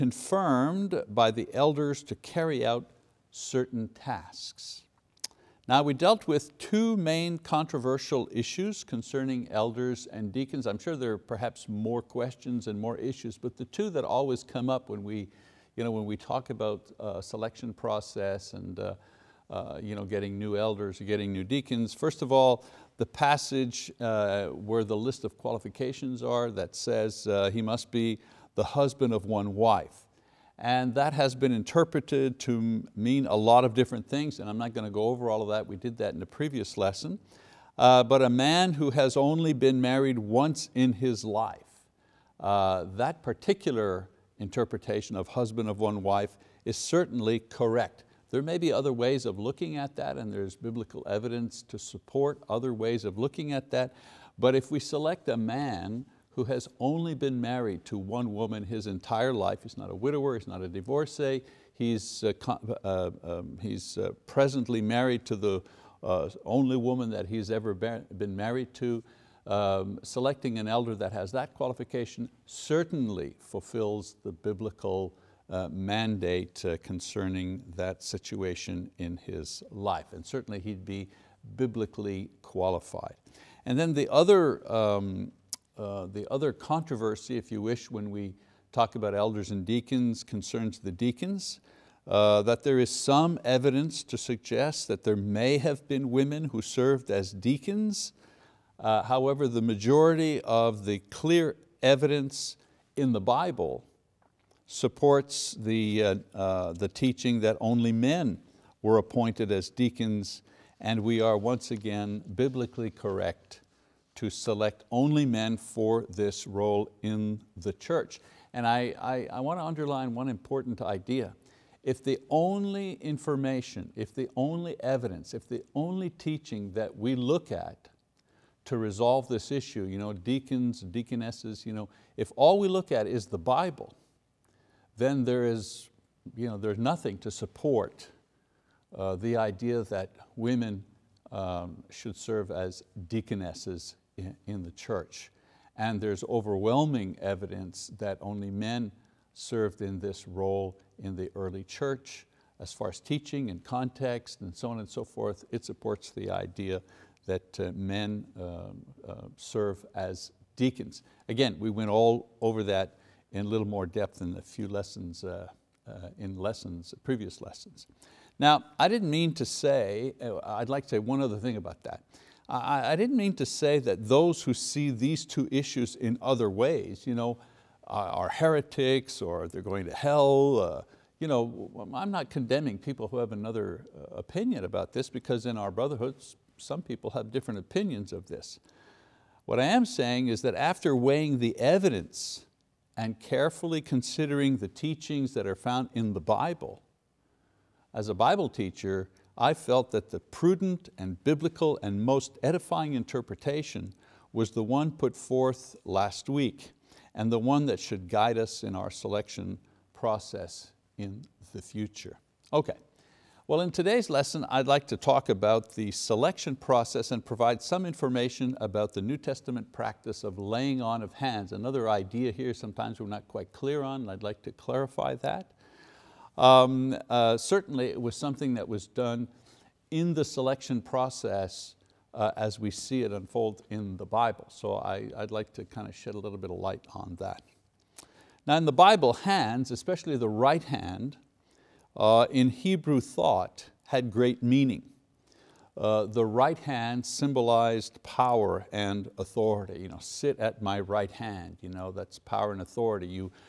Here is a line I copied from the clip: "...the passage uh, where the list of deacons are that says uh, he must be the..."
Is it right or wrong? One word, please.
wrong.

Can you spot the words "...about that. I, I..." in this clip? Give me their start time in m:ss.
2:51.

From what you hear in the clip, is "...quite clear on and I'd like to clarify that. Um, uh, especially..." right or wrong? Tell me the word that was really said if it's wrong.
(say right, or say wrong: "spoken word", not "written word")
wrong: "certainly", not "especially".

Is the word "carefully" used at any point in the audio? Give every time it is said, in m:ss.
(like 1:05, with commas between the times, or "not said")
3:13.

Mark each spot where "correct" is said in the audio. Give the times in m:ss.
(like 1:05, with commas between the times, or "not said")
0:47, 1:52.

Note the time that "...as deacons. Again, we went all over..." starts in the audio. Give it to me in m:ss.
2:39.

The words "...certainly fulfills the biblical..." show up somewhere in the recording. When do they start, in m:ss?
1:12.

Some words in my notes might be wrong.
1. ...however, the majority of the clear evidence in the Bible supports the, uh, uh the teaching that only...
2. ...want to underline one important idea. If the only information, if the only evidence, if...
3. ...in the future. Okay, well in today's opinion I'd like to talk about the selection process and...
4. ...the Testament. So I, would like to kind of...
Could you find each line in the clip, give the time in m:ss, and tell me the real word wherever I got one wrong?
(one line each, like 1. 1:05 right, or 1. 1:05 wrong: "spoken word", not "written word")
1. 1:39 right
2. 1:59 right
3. 3:30 wrong: "lesson", not "opinion"
4. 3:53 wrong: "Bible", not "Testament".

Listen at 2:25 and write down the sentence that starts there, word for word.
And there's overwhelming evidence that only men served in this role in the early church.